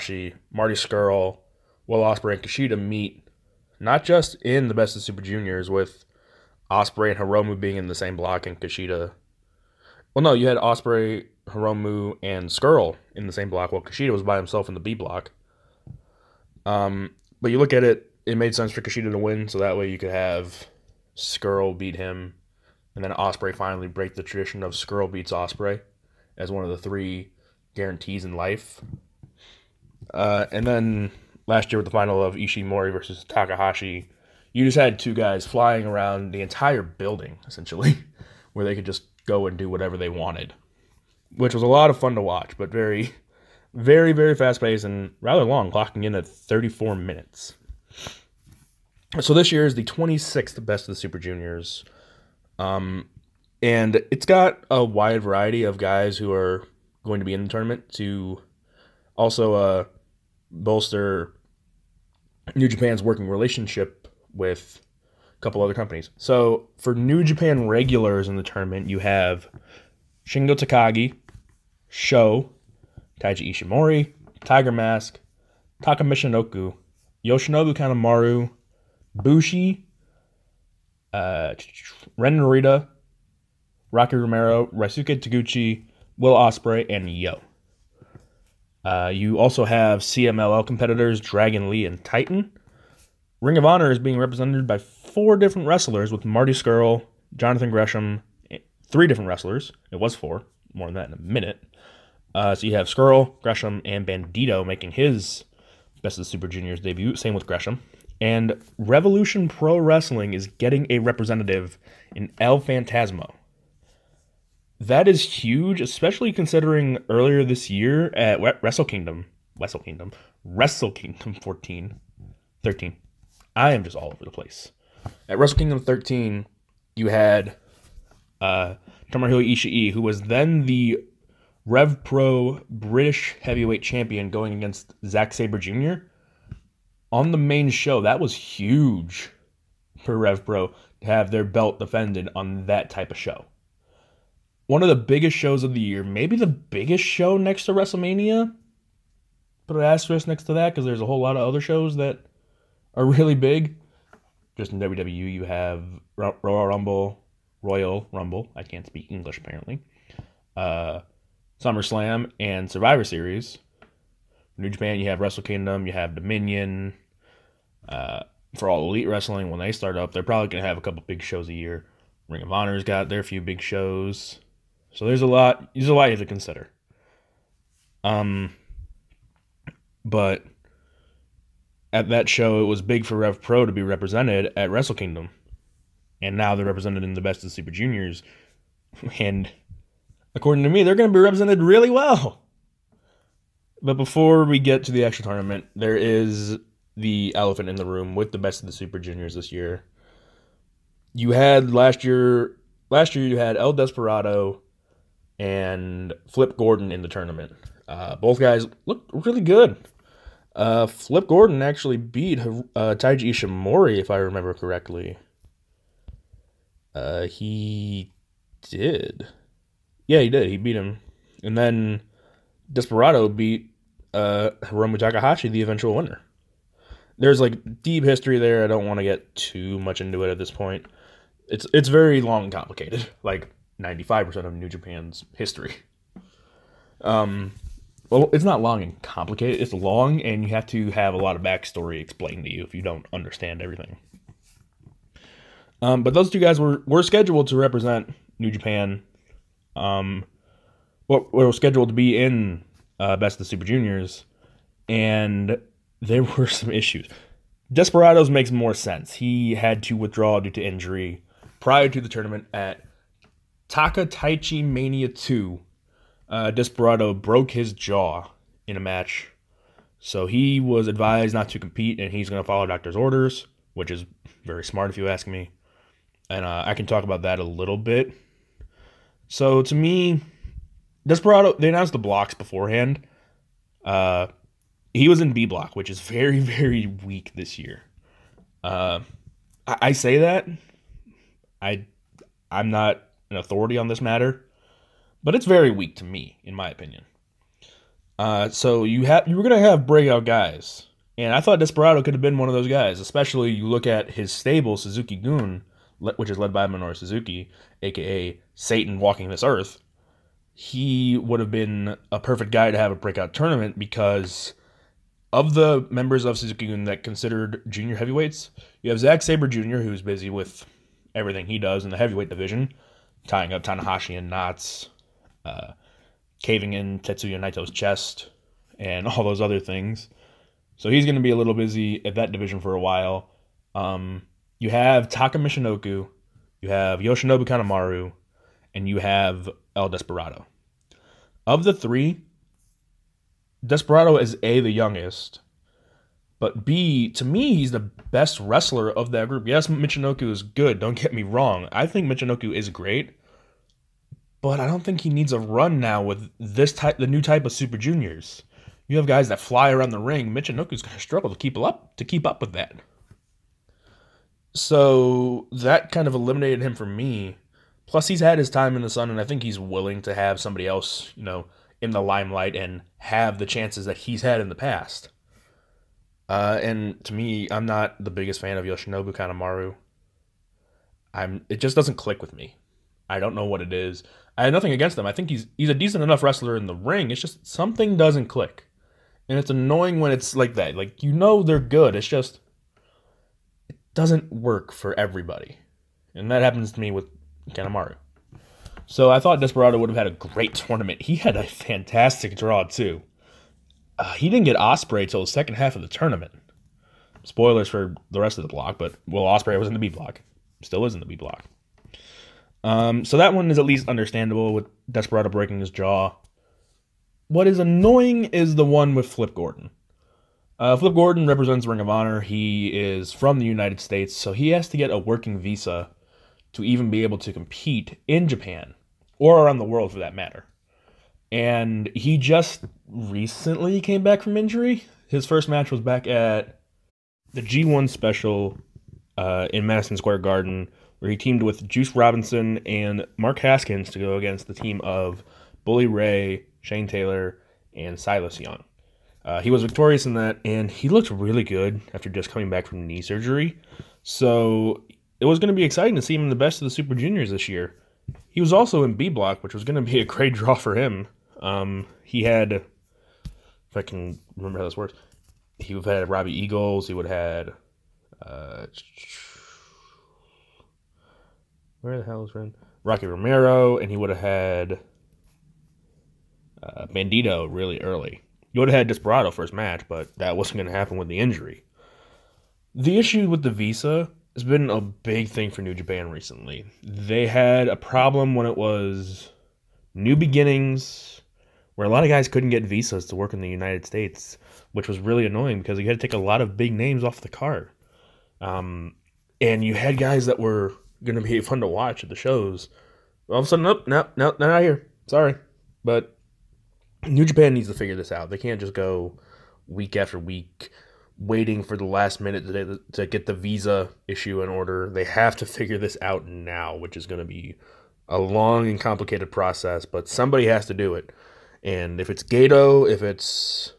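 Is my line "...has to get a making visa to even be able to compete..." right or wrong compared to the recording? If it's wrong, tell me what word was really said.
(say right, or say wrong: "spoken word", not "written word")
wrong: "working", not "making".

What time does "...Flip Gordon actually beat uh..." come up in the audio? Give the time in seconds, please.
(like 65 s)
210 s.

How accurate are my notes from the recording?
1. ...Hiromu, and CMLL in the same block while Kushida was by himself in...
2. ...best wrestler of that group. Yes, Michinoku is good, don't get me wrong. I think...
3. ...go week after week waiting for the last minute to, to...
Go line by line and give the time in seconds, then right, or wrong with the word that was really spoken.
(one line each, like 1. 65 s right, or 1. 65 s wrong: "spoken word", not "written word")
1. 11 s wrong: "Scurll", not "CMLL"
2. 347 s right
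3. 508 s right.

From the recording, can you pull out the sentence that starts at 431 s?
And he just recently came back from injury.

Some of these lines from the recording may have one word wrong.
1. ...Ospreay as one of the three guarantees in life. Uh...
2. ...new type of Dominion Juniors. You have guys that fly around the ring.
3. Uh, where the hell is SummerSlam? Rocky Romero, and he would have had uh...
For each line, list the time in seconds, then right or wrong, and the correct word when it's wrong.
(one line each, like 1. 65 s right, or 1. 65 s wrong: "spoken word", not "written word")
1. 25 s right
2. 357 s wrong: "Super", not "Dominion"
3. 468 s wrong: "Ren", not "SummerSlam".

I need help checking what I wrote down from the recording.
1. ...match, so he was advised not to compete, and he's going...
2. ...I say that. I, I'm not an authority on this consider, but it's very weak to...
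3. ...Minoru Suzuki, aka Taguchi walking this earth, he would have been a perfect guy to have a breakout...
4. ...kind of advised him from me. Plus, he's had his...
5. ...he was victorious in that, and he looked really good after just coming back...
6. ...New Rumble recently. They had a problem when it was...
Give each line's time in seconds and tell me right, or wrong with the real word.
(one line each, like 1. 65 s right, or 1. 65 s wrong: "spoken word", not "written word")
1. 268 s right
2. 289 s wrong: "matter", not "consider"
3. 306 s wrong: "Satan", not "Taguchi"
4. 365 s wrong: "eliminated", not "advised"
5. 449 s right
6. 485 s wrong: "Japan", not "Rumble".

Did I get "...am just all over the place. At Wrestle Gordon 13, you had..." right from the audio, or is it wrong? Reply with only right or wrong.
wrong.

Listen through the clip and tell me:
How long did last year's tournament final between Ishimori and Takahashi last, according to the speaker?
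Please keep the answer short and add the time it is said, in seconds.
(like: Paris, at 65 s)
34 minutes, at 46 s.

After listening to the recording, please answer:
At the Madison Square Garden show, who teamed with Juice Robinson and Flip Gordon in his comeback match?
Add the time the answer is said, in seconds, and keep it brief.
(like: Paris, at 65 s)
Mark Haskins, at 443 s.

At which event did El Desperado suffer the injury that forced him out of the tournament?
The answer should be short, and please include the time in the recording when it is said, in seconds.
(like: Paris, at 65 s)
Taka Taichi Mania 2, at 263 s.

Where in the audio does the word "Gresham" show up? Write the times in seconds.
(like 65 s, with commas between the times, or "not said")
97 s, 103 s, 107 s.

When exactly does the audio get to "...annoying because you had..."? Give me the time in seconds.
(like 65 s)
495 s.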